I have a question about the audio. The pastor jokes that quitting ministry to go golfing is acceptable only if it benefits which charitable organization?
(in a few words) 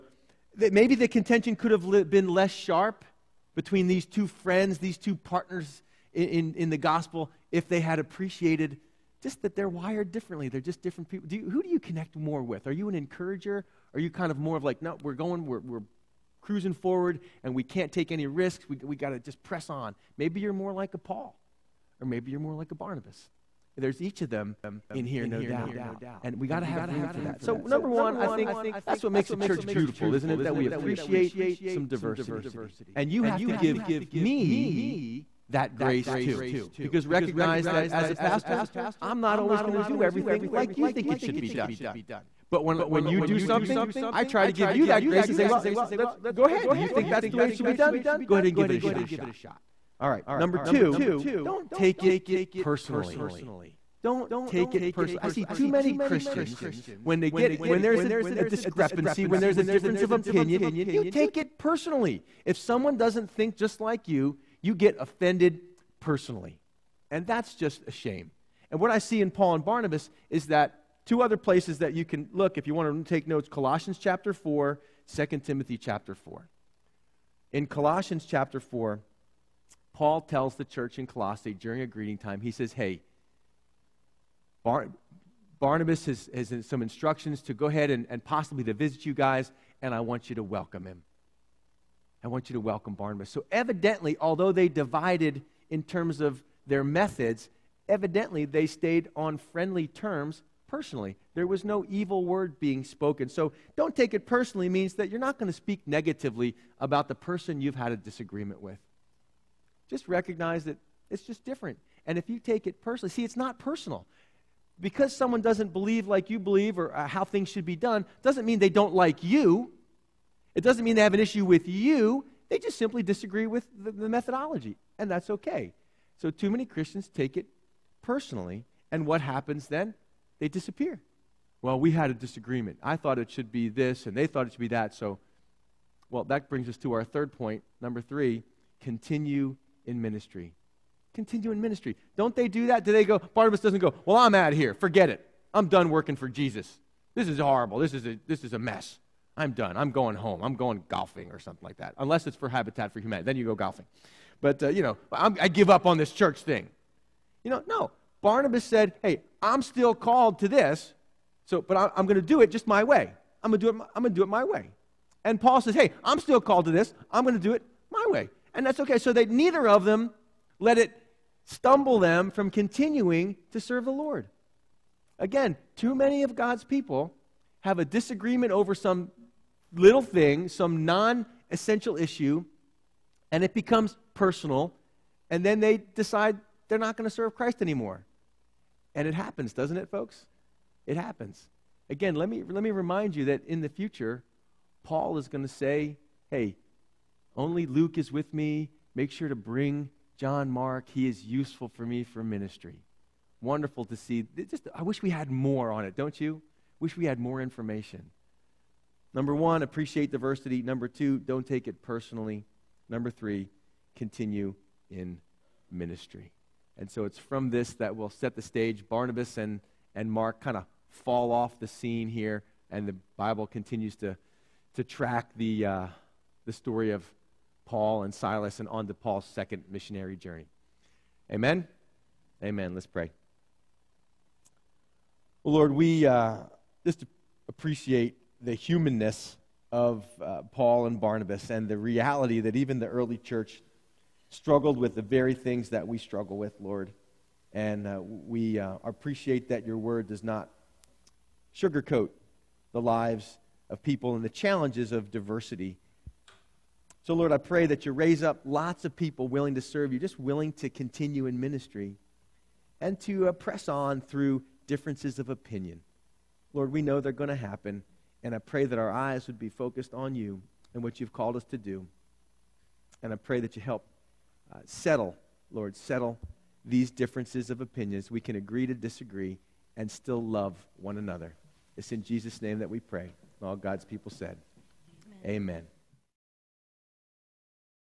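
Habitat for Humanity.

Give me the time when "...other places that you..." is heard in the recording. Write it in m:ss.
1:11.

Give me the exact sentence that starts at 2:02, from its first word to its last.
They just simply disagree with the, the methodology, and that's okay.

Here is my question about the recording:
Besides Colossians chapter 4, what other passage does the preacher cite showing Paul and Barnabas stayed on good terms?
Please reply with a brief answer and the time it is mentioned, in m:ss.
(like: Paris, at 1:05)
2 Timothy chapter 4, at 1:15.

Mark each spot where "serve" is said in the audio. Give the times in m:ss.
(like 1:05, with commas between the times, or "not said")
2:53, 3:07, 4:19.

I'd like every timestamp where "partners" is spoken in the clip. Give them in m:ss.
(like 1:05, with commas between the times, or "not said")
0:05.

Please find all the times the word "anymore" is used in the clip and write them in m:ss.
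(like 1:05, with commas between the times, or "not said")
3:07.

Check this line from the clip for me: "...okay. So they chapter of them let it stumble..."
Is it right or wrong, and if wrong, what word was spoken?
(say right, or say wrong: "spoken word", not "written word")
wrong: "neither", not "chapter".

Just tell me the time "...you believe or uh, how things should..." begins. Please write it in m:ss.
1:56.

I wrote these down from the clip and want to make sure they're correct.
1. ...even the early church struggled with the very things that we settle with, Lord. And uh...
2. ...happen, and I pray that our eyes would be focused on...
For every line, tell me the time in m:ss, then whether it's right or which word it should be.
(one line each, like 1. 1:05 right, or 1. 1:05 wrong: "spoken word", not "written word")
1. 4:02 wrong: "struggle", not "settle"
2. 4:27 right.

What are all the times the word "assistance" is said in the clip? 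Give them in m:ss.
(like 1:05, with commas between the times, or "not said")
not said.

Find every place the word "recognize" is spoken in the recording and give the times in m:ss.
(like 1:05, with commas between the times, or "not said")
0:37, 1:50.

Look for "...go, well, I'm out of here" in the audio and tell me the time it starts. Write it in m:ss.
2:23.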